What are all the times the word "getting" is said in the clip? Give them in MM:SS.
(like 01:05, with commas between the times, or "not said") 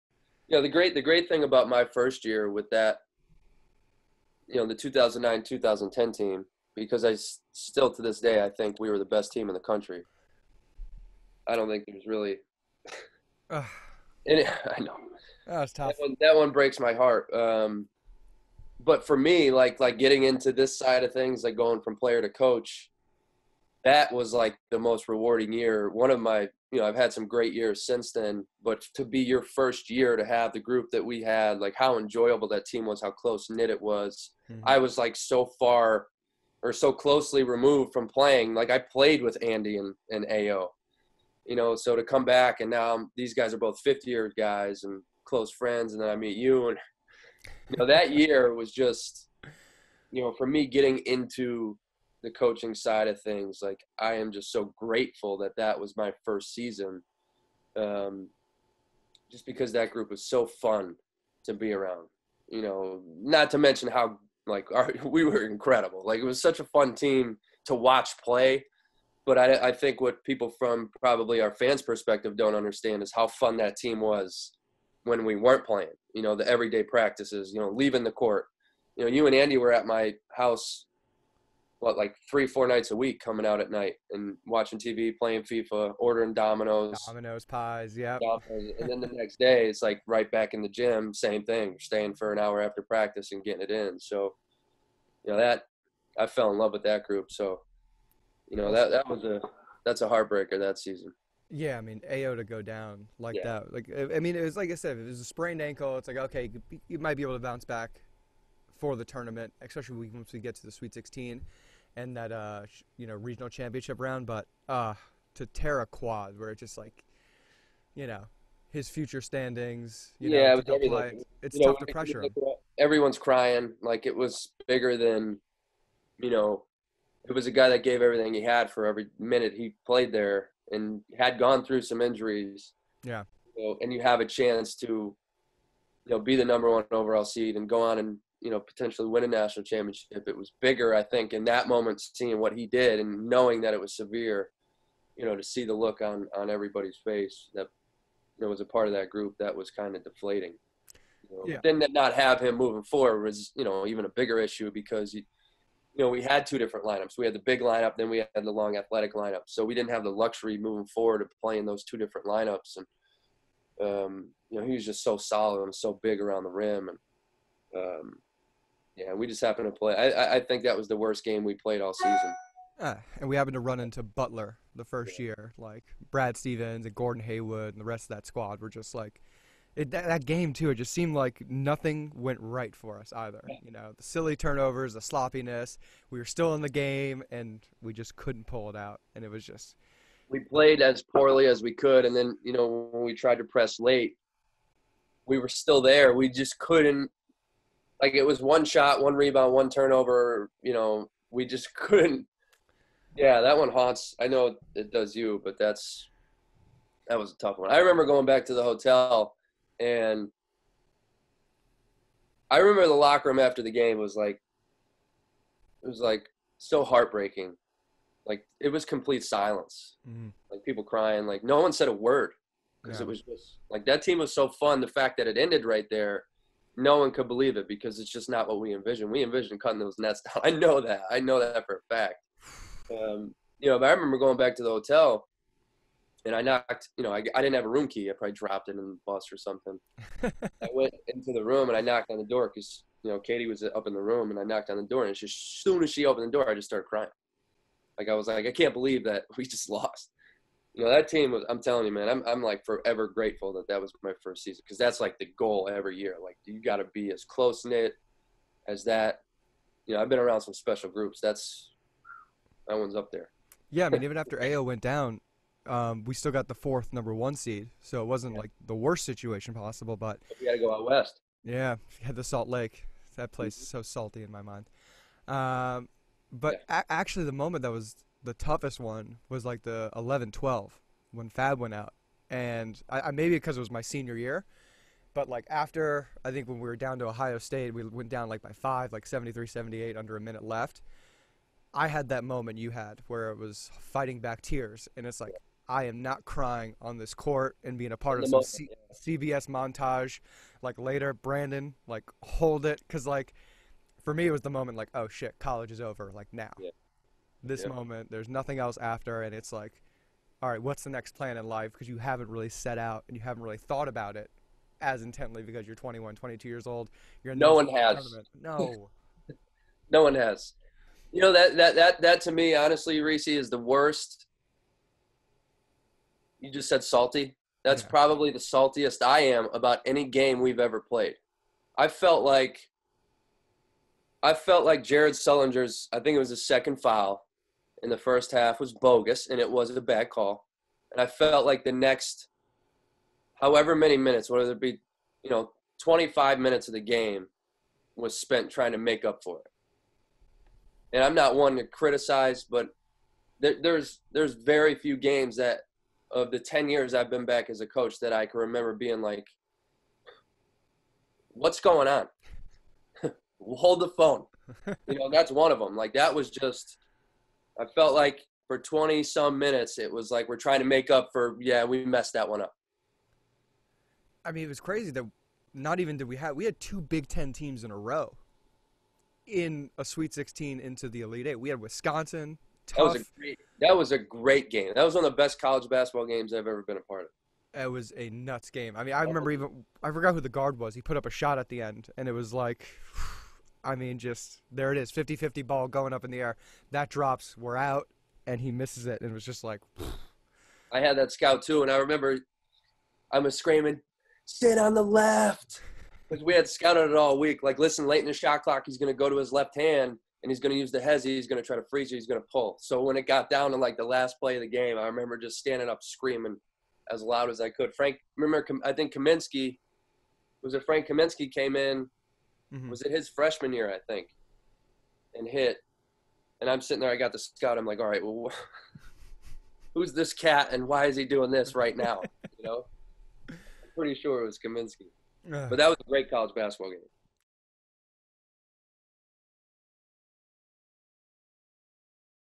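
00:19, 00:50, 01:33.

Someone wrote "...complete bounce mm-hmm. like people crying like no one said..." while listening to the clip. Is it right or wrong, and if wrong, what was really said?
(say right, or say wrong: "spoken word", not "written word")
wrong: "silence", not "bounce".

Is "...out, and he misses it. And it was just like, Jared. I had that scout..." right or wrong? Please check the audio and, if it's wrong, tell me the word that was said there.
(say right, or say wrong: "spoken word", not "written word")
wrong: "Phew", not "Jared".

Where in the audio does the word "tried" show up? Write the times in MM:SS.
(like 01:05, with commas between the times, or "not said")
03:13.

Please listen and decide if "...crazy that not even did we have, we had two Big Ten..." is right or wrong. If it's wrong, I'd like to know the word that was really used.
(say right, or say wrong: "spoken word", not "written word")
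right.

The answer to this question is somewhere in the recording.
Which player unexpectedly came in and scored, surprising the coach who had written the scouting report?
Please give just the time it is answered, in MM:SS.
07:00.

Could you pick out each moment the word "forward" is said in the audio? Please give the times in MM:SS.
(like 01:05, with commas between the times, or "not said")
02:32, 02:40.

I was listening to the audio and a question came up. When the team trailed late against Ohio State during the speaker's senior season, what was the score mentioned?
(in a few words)
73-78.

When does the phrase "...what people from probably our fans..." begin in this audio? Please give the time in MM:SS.
01:10.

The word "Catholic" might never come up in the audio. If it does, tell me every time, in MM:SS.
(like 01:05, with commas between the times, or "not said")
not said.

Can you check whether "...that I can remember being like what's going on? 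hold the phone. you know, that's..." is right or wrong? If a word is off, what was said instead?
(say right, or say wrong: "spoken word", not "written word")
right.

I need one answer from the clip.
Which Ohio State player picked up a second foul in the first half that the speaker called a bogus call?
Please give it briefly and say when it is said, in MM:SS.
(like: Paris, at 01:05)
Jared Sullinger, at 05:34.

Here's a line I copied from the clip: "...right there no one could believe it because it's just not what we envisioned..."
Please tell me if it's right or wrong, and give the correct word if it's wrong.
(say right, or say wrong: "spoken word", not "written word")
right.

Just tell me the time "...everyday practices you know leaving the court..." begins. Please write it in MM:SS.
01:16.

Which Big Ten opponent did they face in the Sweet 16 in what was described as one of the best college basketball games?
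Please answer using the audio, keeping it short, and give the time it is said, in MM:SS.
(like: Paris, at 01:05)
Wisconsin, at 06:21.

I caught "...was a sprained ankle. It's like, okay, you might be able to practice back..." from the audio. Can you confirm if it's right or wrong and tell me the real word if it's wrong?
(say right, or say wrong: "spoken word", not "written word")
wrong: "bounce", not "practice".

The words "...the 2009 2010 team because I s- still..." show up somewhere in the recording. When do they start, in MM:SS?
00:04.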